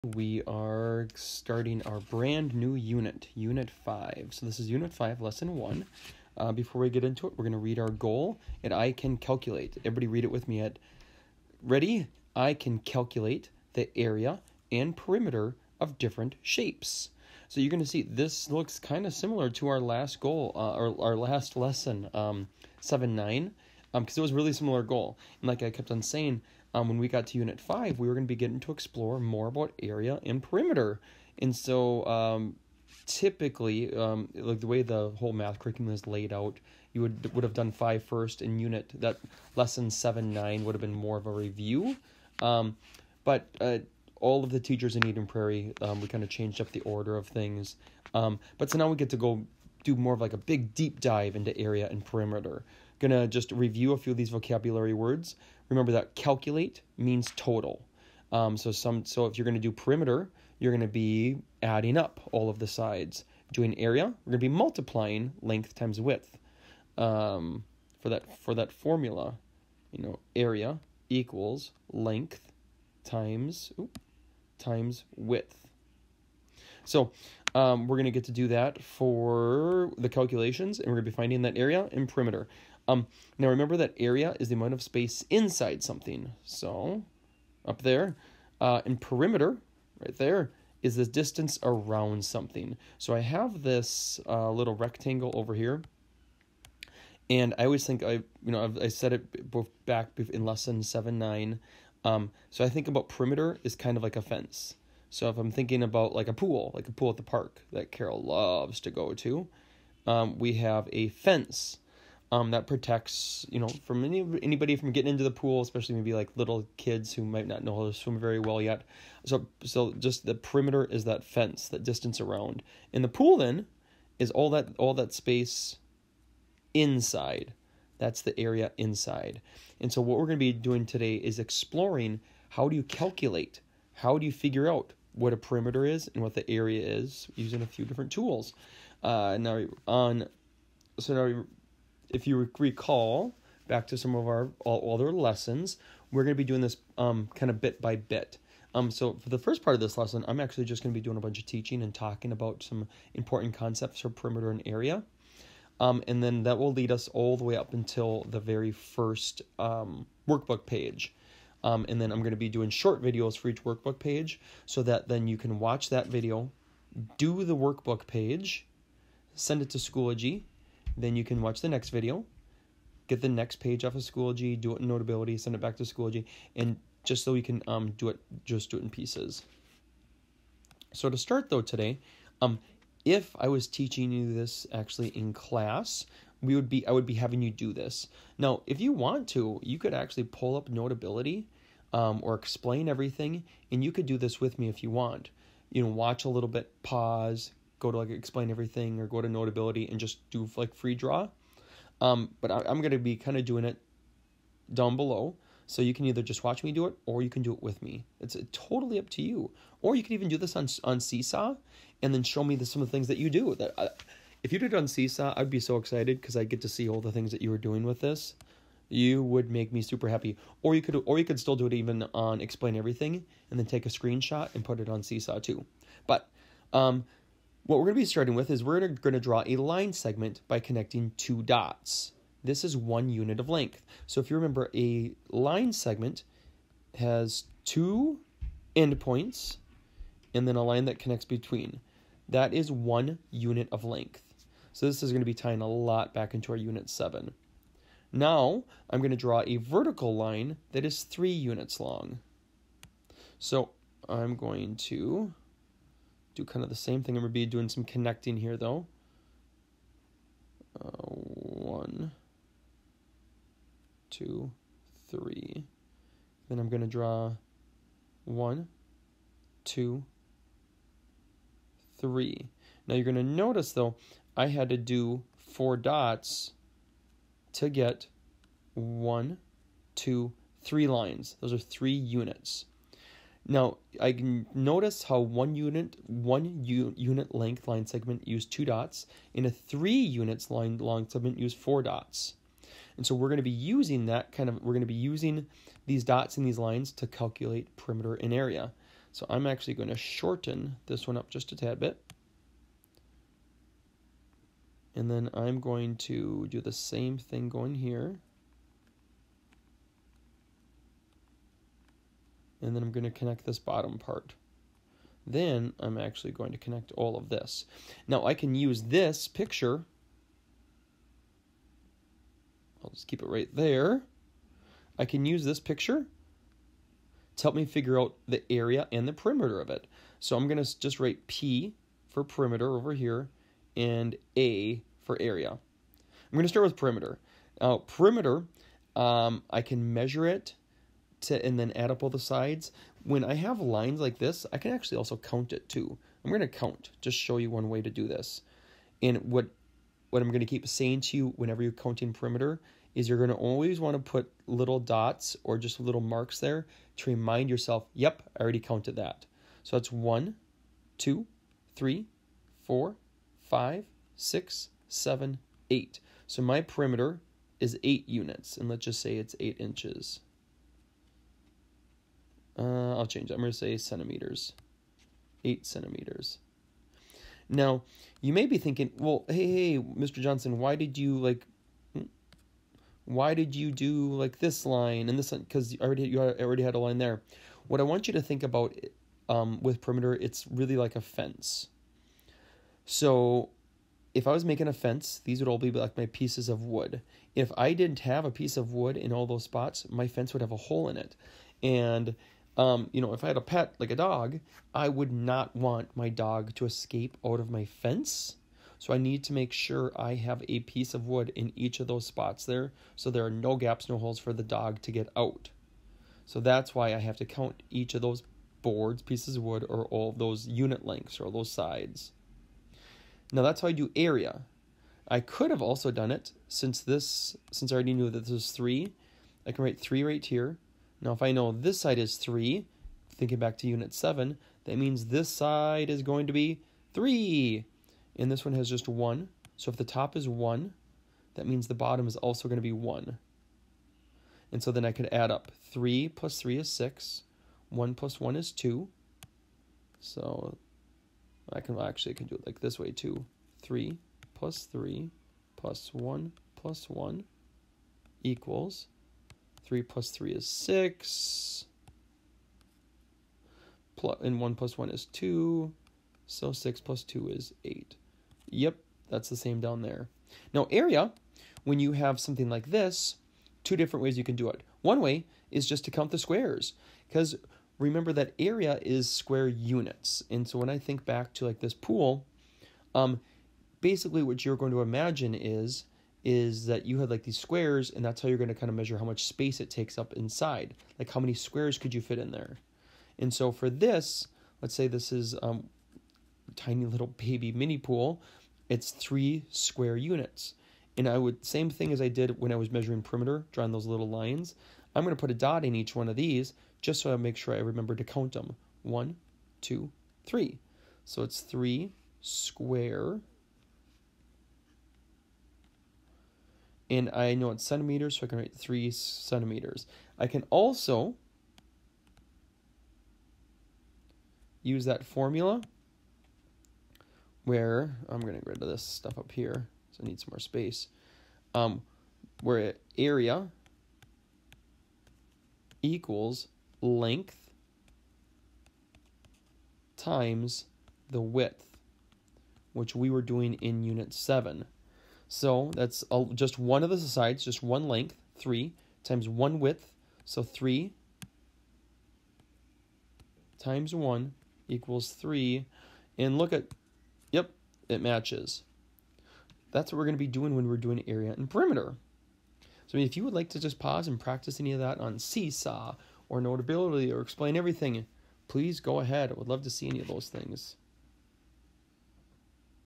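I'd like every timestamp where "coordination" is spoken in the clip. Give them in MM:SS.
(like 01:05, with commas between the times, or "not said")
not said.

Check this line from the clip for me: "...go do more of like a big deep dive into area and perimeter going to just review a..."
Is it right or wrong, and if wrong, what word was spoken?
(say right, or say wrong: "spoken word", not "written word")
right.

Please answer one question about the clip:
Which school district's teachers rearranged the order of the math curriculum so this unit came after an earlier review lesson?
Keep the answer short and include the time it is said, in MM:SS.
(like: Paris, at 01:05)
Eden Prairie, at 00:45.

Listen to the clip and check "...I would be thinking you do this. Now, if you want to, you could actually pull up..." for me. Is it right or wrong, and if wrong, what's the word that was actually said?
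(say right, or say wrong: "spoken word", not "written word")
wrong: "having", not "thinking".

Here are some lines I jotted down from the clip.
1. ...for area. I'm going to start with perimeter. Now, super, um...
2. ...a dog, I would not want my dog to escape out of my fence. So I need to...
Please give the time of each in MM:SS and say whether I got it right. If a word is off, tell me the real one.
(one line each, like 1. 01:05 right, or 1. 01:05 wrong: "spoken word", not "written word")
1. 05:35 wrong: "perimeter", not "super"
2. 06:43 right.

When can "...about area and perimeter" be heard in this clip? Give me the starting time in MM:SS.
00:29.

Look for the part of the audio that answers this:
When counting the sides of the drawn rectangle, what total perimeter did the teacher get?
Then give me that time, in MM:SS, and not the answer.
06:15.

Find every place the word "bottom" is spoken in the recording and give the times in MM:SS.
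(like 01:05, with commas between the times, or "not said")
05:13, 07:21.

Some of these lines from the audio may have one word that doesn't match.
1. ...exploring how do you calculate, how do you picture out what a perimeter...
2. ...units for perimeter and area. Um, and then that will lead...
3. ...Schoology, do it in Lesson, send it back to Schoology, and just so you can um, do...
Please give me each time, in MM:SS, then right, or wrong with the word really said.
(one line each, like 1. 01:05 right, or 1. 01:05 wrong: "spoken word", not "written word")
1. 02:11 wrong: "figure", not "picture"
2. 02:33 wrong: "concepts", not "units"
3. 02:54 wrong: "Notability", not "Lesson".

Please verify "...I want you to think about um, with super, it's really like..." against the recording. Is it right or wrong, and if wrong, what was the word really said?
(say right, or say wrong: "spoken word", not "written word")
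wrong: "perimeter", not "super".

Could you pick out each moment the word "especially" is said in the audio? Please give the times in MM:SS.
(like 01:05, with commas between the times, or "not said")
01:55.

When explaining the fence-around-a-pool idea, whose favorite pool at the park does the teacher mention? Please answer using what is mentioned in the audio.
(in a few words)
Carol.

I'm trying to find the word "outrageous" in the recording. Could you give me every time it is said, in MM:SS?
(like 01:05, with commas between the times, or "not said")
not said.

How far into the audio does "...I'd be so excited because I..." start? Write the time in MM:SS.
03:35.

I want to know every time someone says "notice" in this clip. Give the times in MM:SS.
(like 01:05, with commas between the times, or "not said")
04:33, 04:44.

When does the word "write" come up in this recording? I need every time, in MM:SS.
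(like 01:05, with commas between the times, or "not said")
05:30, 07:09, 08:38.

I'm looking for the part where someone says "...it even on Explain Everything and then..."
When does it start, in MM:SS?
03:41.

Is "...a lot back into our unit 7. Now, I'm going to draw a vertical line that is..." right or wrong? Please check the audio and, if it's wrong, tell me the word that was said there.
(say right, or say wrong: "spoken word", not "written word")
right.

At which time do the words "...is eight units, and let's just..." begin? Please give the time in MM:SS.
06:07.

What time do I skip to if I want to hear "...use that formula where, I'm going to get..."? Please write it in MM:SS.
08:44.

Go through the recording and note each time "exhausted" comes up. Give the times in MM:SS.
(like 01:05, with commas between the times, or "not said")
not said.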